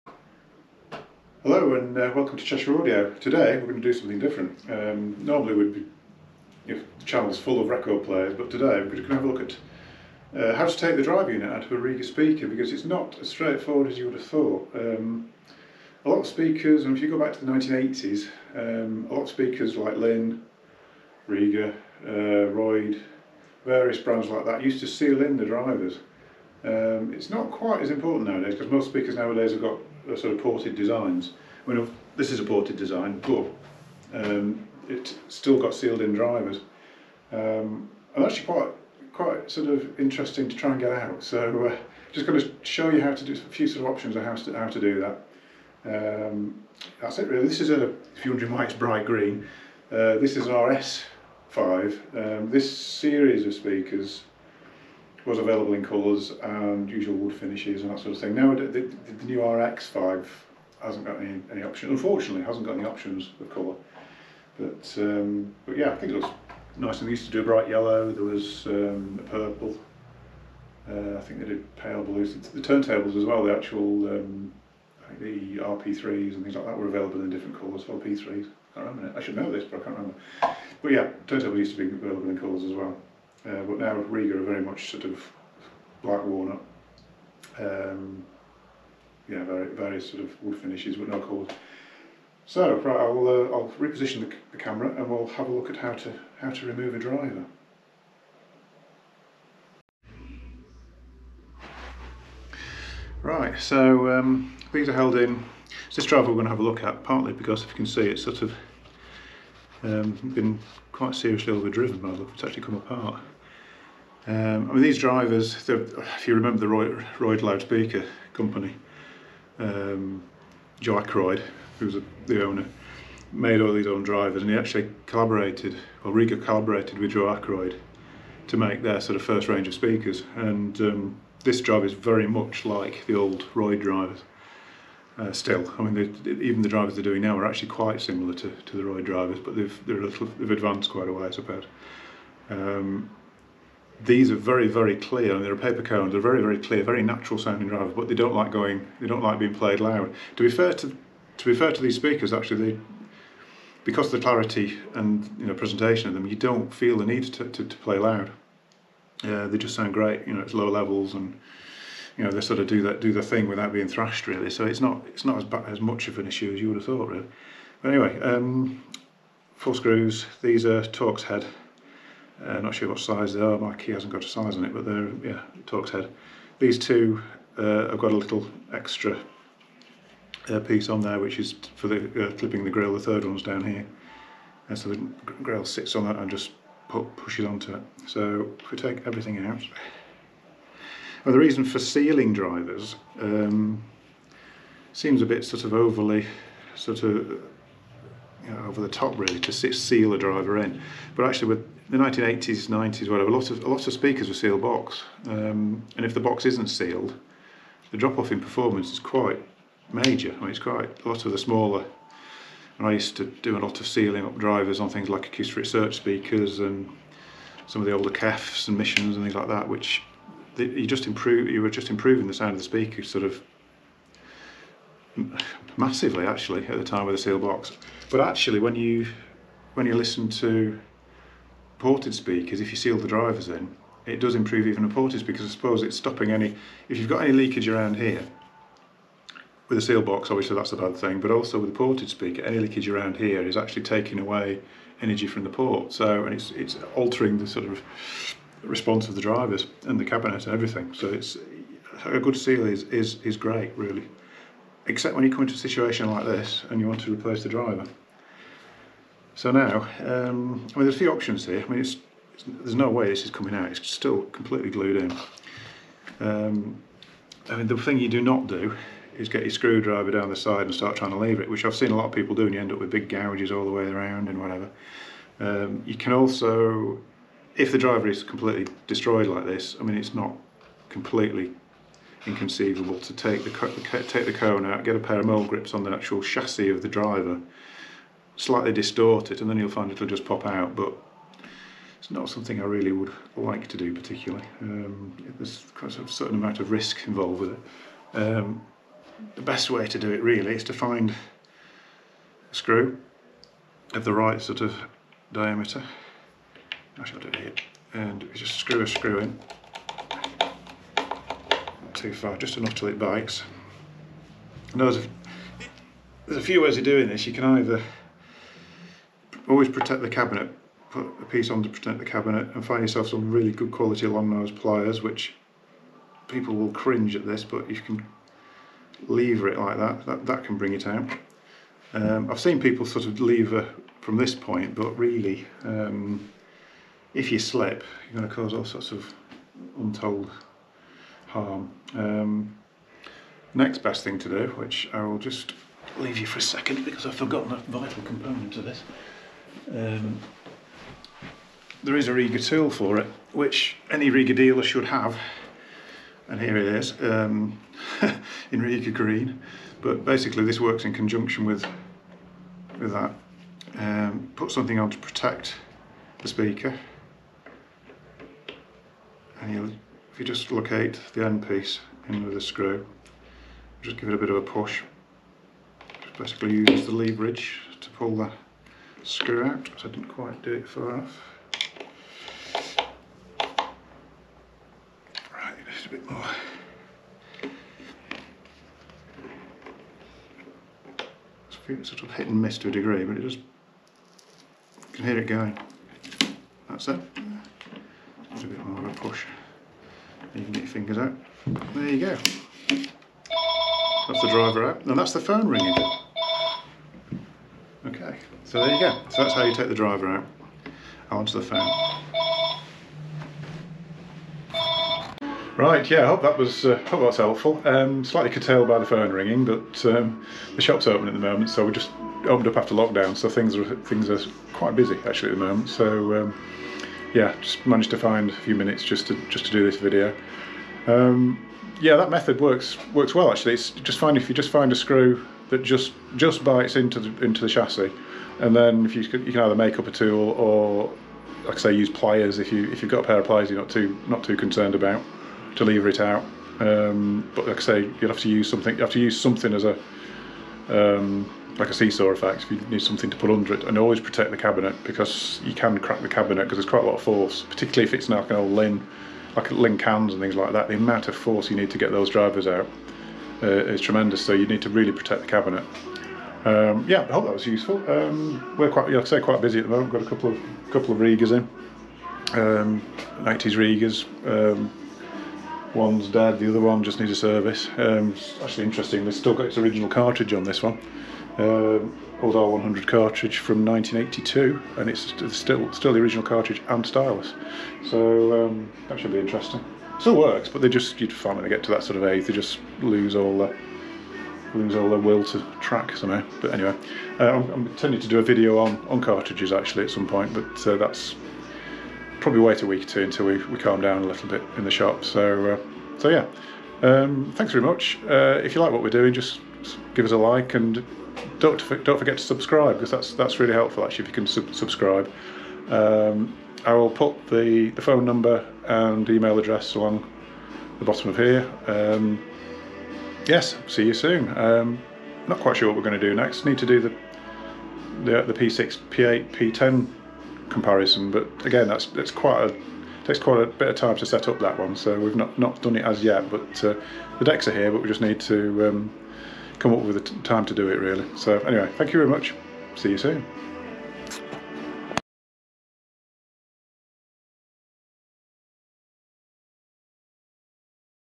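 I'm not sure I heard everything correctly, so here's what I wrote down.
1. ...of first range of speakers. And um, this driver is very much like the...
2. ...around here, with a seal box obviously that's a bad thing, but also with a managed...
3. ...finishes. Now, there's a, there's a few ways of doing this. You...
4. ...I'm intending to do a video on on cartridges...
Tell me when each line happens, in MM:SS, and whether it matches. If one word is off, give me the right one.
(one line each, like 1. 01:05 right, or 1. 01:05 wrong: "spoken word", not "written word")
1. 02:09 right
2. 03:57 wrong: "ported", not "managed"
3. 05:12 wrong: "bites", not "finishes"
4. 08:17 right.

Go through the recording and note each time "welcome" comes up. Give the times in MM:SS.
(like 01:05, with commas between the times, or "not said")
00:02.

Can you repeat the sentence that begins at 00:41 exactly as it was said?
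So uh, just going to show you how to do a few sort of options of how to, how to do that.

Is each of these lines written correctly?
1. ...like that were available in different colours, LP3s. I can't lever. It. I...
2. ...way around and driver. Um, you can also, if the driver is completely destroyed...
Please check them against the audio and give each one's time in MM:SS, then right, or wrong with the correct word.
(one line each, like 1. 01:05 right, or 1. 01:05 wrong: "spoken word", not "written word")
1. 01:16 wrong: "remember", not "lever"
2. 04:33 wrong: "whatever", not "driver".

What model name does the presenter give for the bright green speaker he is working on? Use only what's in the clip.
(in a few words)
RS5.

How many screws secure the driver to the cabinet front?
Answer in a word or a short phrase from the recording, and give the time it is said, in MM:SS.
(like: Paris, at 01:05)
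4, at 02:49.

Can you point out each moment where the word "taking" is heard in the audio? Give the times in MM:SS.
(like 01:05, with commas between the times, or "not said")
04:03.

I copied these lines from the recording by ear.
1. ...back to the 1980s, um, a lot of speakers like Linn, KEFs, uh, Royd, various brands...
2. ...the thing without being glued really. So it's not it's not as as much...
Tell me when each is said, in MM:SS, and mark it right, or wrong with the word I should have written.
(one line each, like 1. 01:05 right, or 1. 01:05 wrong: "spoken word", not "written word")
1. 00:17 wrong: "Rega", not "KEFs"
2. 02:43 wrong: "thrashed", not "glued".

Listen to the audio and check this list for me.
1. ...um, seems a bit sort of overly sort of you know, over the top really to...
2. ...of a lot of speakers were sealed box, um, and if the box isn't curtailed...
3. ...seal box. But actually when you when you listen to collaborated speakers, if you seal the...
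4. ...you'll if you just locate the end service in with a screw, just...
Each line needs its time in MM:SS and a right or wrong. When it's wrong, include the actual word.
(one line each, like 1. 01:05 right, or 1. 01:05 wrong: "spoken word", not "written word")
1. 03:13 right
2. 03:23 wrong: "sealed", not "curtailed"
3. 03:47 wrong: "ported", not "collaborated"
4. 06:09 wrong: "piece", not "service".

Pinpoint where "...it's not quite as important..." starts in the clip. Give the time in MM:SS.
00:27.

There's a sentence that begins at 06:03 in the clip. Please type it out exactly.
Um, put something on to protect the speaker.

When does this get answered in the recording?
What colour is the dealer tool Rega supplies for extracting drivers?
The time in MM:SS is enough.
05:58.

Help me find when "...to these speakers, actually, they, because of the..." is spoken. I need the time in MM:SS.
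02:31.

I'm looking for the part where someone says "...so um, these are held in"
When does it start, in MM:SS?
01:43.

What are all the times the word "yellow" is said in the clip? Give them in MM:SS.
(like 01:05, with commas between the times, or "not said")
01:07.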